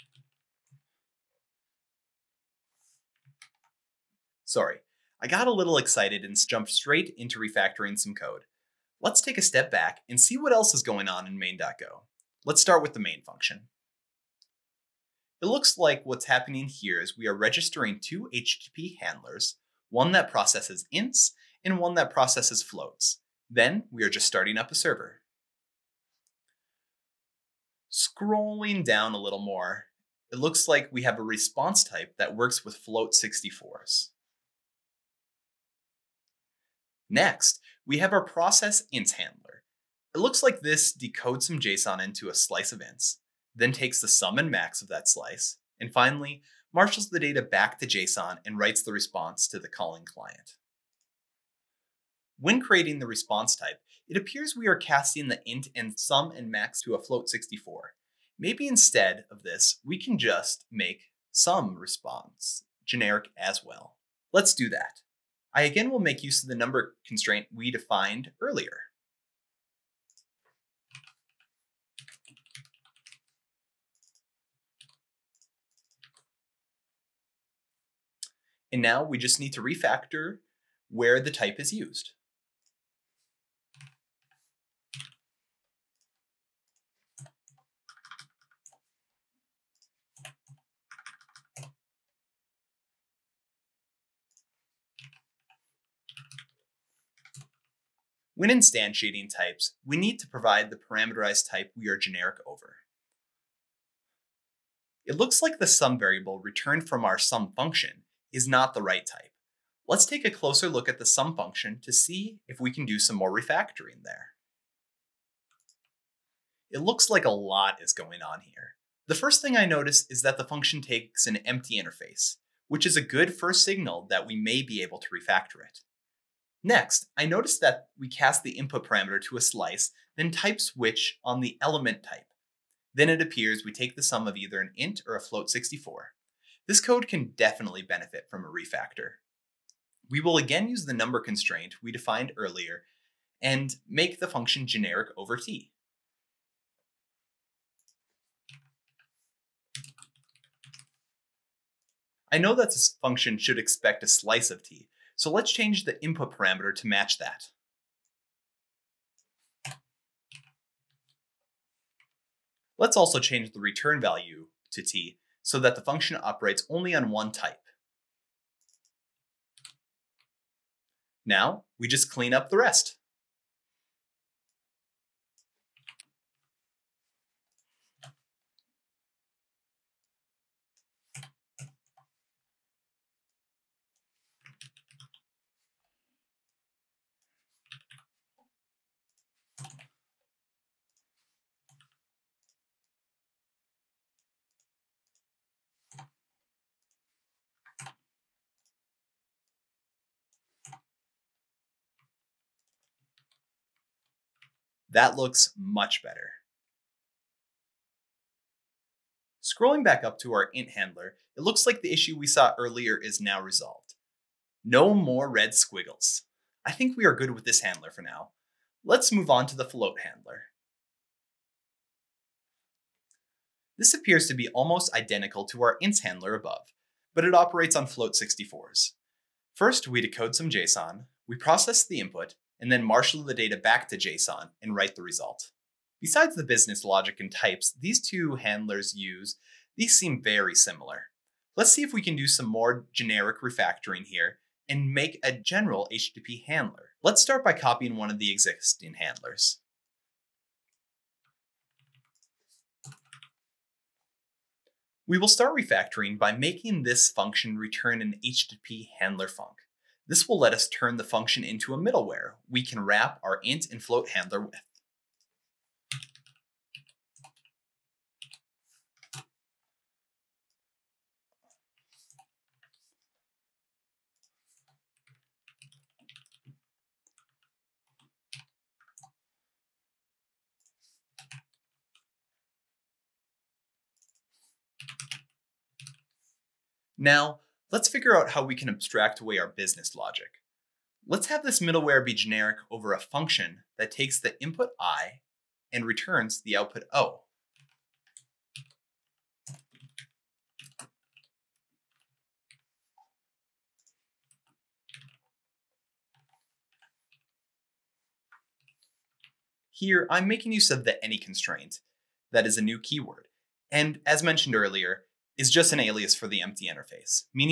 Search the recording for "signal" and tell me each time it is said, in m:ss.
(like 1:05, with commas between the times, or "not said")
2:03.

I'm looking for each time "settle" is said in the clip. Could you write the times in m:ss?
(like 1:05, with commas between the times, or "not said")
not said.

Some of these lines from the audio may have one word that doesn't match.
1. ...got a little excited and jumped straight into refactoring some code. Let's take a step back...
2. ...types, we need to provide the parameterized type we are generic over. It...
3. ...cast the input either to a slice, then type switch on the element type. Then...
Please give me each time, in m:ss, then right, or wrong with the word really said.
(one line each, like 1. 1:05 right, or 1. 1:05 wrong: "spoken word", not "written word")
1. 0:05 right
2. 1:39 right
3. 2:08 wrong: "parameter", not "either".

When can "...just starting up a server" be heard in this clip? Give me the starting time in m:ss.
0:24.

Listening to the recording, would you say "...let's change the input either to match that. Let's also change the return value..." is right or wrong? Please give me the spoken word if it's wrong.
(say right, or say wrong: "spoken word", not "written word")
wrong: "parameter", not "either".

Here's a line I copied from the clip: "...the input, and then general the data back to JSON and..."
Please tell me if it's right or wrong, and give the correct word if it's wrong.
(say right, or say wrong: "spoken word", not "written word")
wrong: "marshal", not "general".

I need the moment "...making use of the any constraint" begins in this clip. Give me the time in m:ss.
5:10.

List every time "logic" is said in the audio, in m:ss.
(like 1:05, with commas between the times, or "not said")
3:56, 4:49.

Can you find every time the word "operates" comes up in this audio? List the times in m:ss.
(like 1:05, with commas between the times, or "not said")
2:46, 3:47.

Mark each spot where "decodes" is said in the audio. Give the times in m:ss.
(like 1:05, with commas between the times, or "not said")
0:40, 3:49.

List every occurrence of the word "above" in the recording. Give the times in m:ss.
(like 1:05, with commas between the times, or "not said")
3:46.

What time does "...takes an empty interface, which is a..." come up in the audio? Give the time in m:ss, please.
2:00.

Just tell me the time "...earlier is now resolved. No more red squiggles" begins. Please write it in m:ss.
3:32.